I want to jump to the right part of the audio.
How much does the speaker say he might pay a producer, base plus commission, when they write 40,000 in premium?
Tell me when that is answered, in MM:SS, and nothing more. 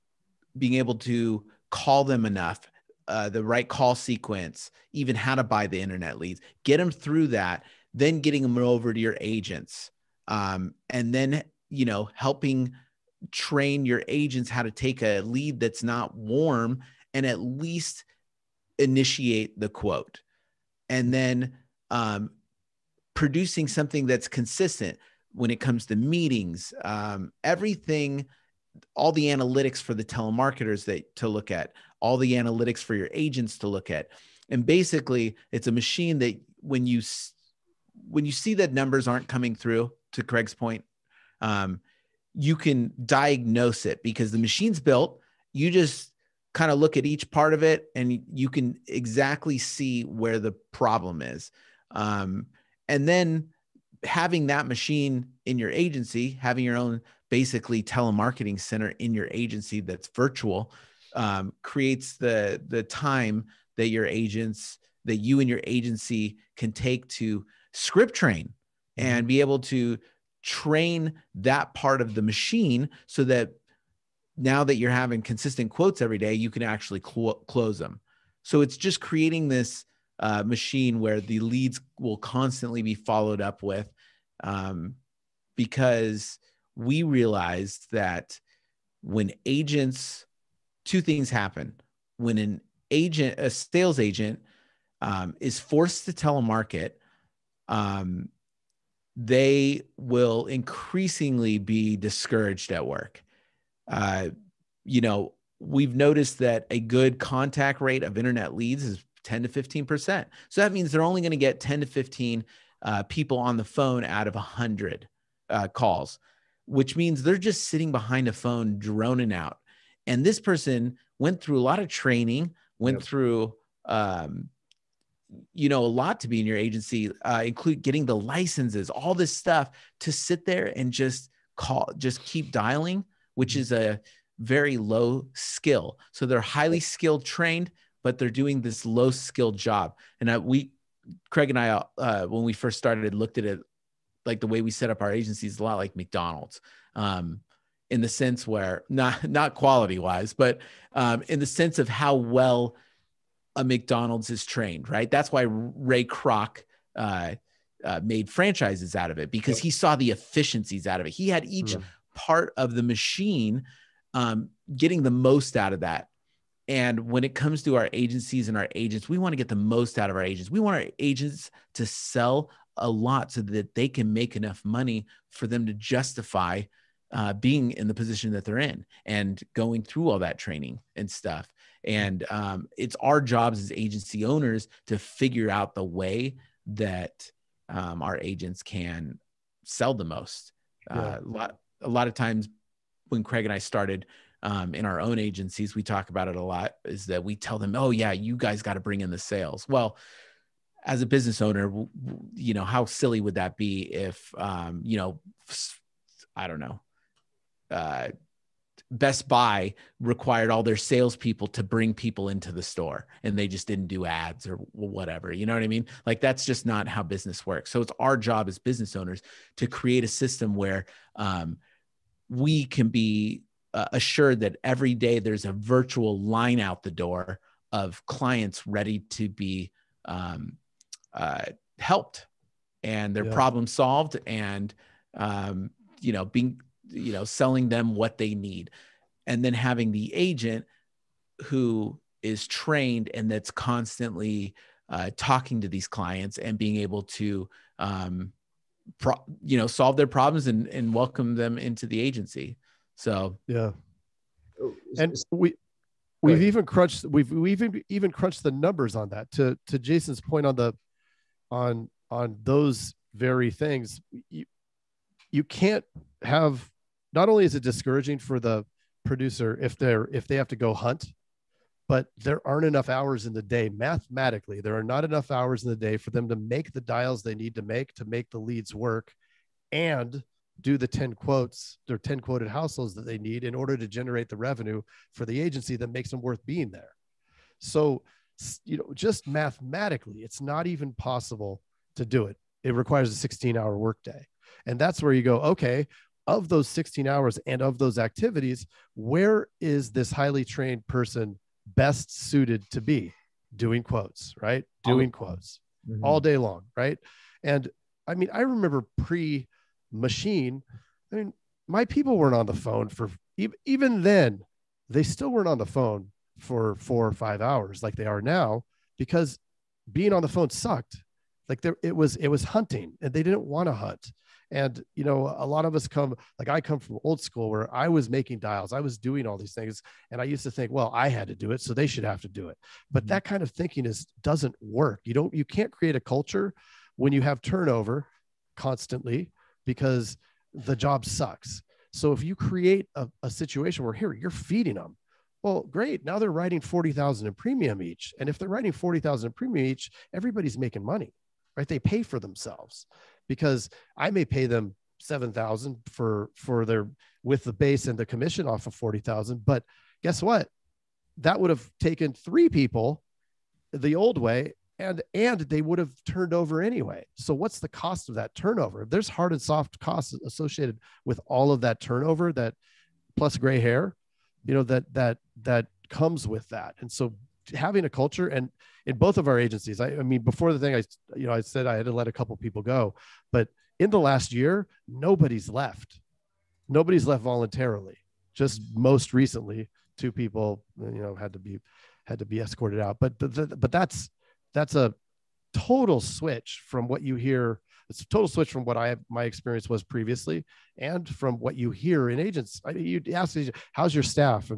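05:54.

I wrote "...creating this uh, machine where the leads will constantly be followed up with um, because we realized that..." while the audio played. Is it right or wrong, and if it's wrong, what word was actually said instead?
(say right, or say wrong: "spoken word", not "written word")
right.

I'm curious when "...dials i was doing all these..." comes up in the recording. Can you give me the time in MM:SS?
05:28.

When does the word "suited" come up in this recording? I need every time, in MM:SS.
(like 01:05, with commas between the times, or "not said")
05:02.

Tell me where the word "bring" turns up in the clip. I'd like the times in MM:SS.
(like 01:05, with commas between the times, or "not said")
03:18, 03:31.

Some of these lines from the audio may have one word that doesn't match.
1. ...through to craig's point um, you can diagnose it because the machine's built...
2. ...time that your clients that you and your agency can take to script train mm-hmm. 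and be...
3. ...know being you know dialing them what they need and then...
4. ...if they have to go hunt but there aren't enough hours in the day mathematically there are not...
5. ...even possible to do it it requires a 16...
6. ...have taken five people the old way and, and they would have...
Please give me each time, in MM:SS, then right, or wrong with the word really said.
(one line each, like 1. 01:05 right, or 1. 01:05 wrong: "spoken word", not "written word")
1. 00:39 right
2. 01:02 wrong: "agents", not "clients"
3. 03:56 wrong: "selling", not "dialing"
4. 04:30 right
5. 04:50 right
6. 06:01 wrong: "three", not "five".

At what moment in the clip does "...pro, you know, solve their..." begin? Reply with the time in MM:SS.
04:08.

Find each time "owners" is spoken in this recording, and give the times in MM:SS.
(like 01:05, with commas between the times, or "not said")
03:04, 03:21, 03:38.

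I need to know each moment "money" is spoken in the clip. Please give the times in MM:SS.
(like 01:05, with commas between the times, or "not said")
02:54, 05:50.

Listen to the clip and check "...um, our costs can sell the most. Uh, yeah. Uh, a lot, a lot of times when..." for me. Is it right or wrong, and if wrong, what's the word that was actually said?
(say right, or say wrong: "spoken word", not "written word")
wrong: "agents", not "costs".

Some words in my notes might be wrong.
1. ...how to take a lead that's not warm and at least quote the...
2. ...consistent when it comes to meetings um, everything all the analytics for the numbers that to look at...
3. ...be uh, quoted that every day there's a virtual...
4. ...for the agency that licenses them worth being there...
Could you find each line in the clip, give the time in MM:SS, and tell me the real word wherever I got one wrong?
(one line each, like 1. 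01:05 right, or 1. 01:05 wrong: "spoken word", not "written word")
1. 00:14 wrong: "initiate", not "quote"
2. 00:24 wrong: "telemarketers", not "numbers"
3. 03:42 wrong: "assured", not "quoted"
4. 04:45 wrong: "makes", not "licenses".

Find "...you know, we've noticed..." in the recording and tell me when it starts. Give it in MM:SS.
01:44.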